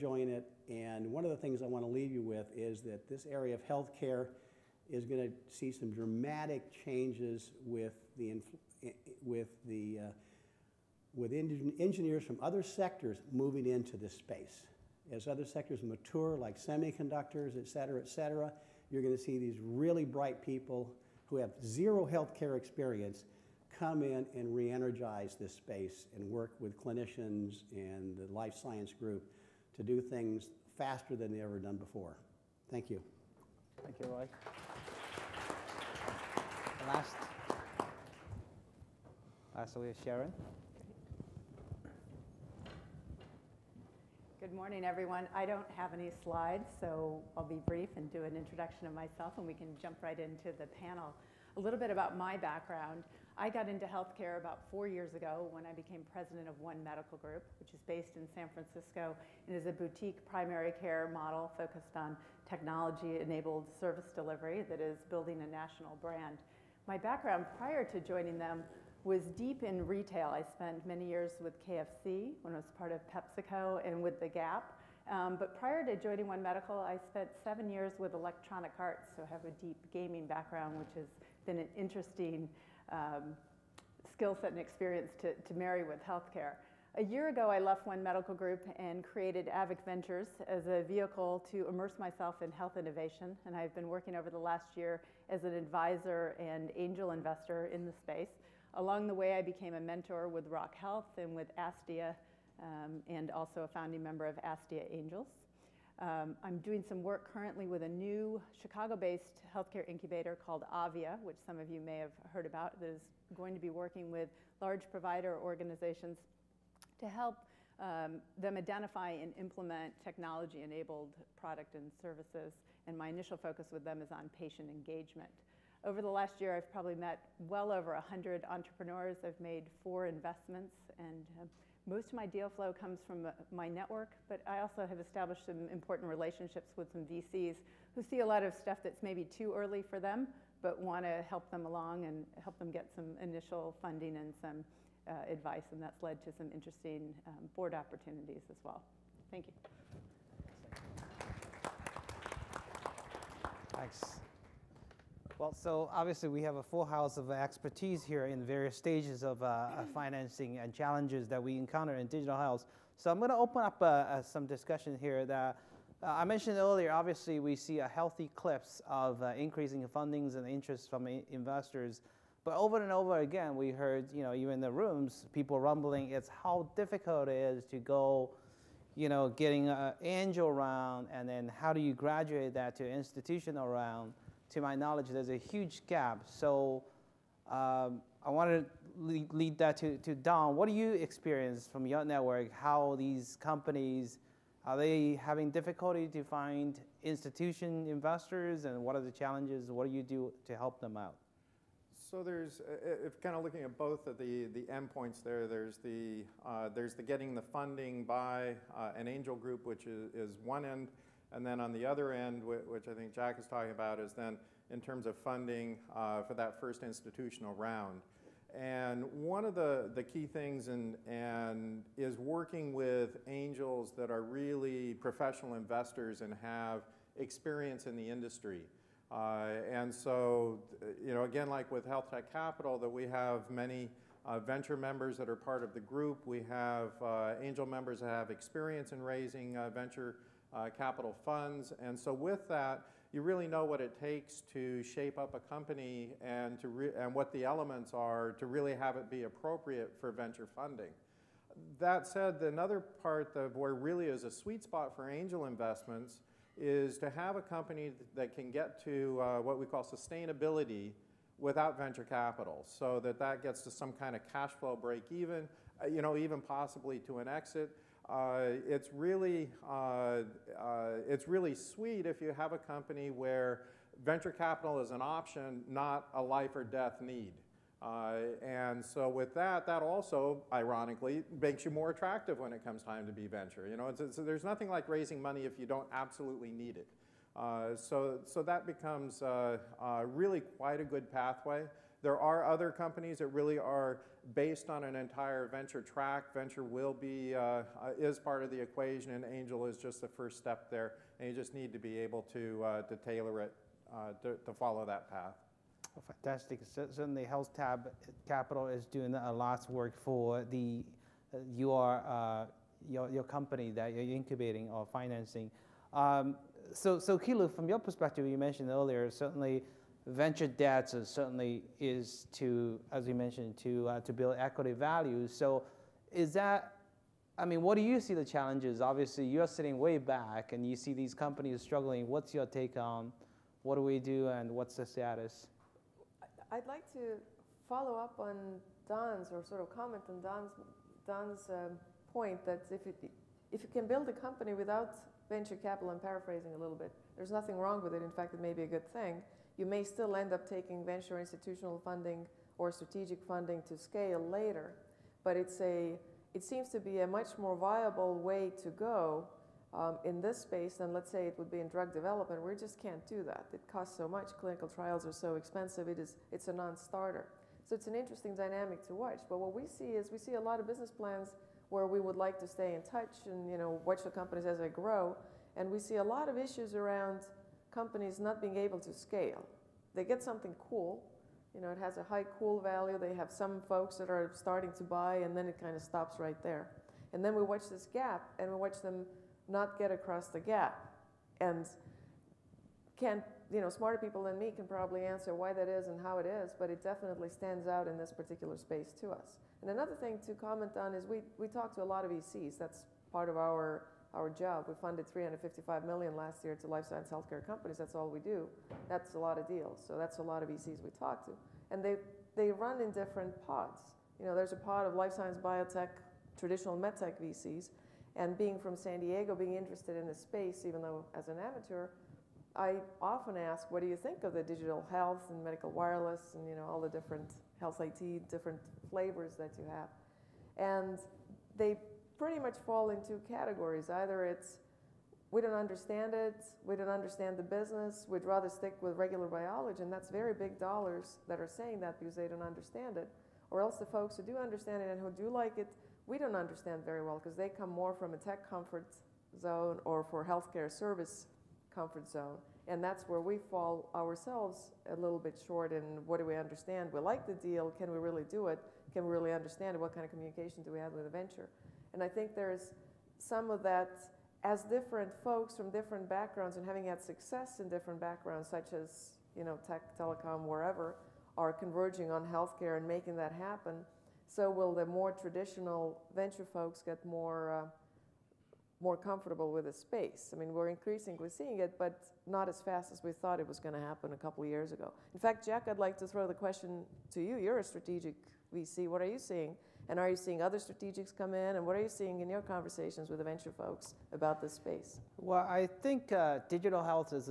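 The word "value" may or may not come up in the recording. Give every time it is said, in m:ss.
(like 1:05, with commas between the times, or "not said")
5:24, 6:22.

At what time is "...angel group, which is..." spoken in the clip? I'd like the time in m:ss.
3:29.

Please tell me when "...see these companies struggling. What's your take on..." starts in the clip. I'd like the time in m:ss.
5:30.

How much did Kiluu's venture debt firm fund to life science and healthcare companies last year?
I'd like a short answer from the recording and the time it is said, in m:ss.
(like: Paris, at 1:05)
355 million, at 6:45.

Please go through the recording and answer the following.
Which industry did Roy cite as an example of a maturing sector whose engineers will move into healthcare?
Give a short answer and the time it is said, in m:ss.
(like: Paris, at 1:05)
semiconductors, at 0:16.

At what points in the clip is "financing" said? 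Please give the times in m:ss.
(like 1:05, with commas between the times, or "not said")
2:39, 5:14.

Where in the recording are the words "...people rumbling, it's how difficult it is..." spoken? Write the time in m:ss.
2:55.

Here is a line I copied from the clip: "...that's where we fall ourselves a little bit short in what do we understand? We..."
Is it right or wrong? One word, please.
right.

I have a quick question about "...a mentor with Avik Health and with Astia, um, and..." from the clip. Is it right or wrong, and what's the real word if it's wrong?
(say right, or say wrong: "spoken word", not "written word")
wrong: "Rock", not "Avik".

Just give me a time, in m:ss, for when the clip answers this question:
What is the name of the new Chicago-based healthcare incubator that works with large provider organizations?
1:50.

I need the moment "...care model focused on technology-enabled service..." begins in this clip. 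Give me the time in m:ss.
1:00.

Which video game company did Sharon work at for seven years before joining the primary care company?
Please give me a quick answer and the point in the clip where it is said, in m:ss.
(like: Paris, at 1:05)
Electronic Arts, at 1:18.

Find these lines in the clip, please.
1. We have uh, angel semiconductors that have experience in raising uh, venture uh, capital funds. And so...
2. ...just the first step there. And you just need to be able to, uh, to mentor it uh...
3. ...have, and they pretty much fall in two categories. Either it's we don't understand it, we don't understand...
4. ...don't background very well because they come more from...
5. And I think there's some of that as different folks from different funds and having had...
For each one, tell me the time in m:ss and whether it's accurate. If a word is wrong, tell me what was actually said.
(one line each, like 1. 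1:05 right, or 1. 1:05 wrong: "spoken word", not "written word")
1. 3:56 wrong: "members", not "semiconductors"
2. 4:59 wrong: "tailor", not "mentor"
3. 7:09 right
4. 7:26 wrong: "understand", not "background"
5. 7:41 wrong: "backgrounds", not "funds".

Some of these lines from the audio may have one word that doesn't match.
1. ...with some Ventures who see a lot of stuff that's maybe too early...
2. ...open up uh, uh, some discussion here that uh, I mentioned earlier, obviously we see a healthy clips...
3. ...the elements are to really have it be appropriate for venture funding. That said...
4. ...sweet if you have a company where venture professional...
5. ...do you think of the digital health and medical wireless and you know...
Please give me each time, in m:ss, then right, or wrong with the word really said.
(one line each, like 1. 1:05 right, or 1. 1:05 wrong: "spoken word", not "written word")
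1. 2:16 wrong: "VCs", not "Ventures"
2. 2:43 right
3. 4:07 right
4. 4:31 wrong: "capital", not "professional"
5. 7:03 right.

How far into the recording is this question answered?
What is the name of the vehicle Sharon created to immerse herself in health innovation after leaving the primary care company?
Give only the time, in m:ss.
1:29.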